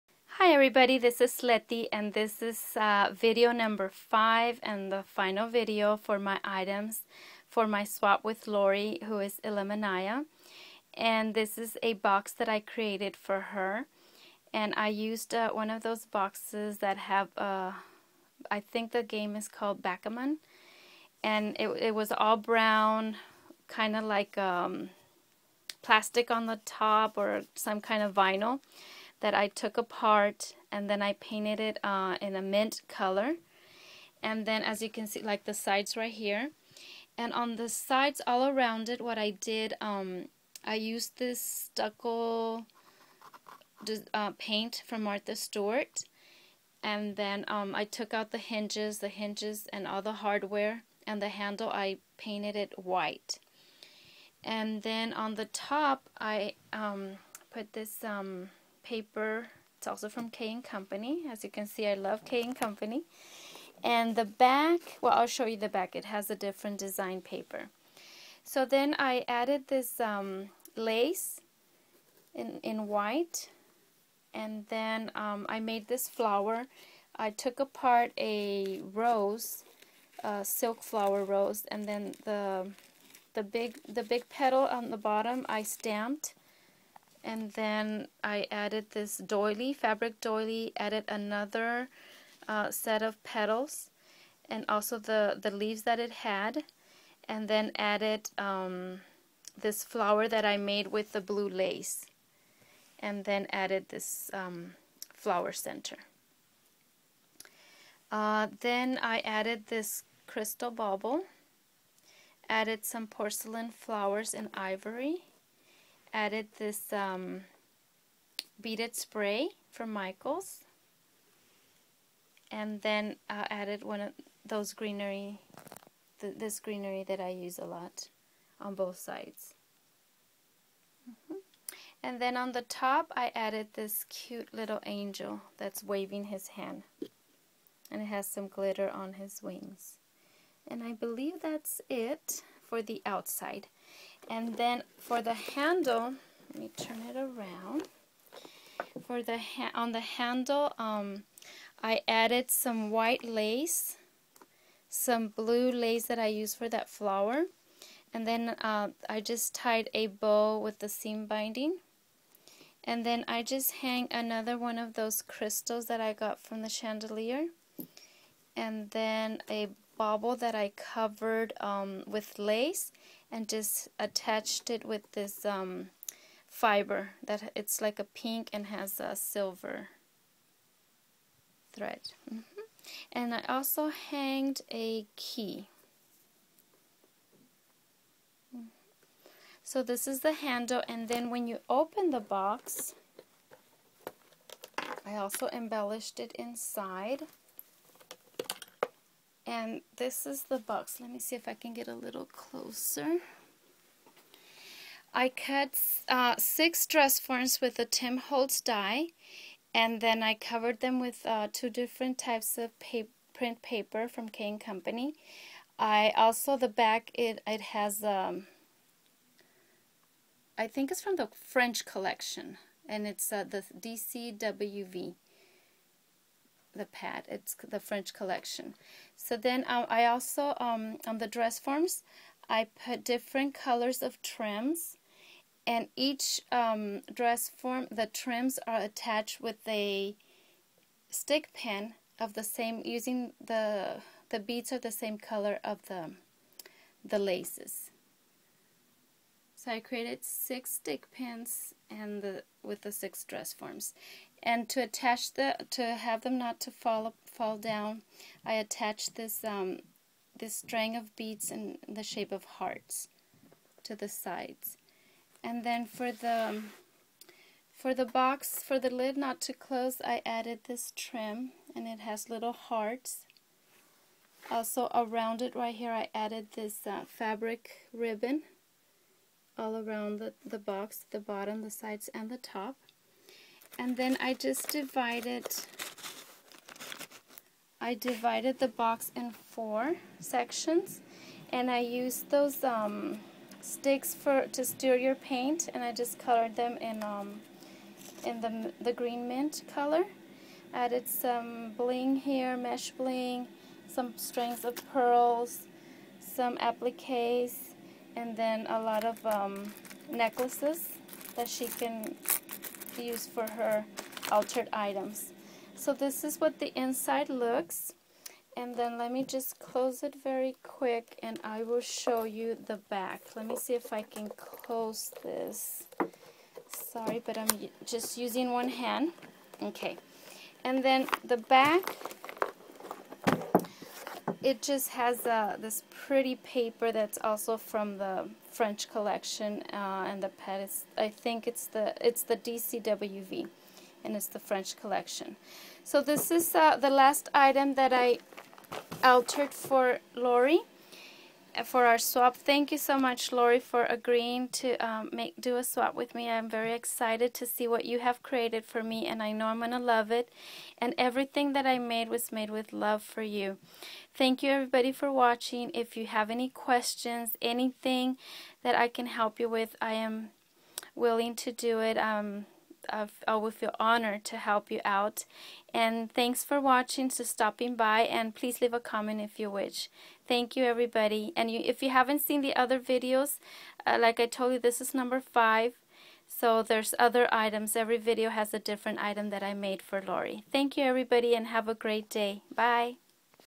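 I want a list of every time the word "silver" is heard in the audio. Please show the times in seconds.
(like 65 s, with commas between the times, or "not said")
179 s.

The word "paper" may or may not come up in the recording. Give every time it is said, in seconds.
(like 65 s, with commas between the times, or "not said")
58 s, 67 s, 213 s, 336 s.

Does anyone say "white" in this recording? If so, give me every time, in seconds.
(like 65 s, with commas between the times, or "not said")
52 s, 72 s, 152 s.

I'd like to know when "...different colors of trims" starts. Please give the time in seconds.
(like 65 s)
233 s.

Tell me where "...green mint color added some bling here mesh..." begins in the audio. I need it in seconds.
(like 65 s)
298 s.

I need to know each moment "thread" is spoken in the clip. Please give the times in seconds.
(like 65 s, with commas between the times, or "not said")
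181 s.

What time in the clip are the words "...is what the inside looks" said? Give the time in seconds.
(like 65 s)
316 s.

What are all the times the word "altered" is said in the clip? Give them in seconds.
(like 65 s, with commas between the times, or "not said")
314 s, 349 s.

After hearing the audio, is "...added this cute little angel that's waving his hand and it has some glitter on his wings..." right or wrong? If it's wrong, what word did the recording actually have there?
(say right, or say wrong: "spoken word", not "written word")
right.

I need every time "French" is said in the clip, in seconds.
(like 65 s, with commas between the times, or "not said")
221 s, 227 s, 338 s, 344 s.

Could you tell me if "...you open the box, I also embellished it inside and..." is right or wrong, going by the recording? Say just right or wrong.
right.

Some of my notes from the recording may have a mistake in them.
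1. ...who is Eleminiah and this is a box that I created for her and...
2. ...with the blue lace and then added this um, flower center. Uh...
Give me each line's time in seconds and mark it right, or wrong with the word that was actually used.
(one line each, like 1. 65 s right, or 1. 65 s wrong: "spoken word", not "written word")
1. 9 s right
2. 100 s right.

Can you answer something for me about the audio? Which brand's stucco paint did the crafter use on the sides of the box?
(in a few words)
Martha Stewart.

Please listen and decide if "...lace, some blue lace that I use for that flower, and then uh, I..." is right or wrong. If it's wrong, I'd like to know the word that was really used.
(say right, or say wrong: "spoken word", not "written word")
right.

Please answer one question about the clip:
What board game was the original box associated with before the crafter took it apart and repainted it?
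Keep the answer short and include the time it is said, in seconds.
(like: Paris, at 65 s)
Backgammon, at 19 s.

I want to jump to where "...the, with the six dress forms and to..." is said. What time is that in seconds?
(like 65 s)
252 s.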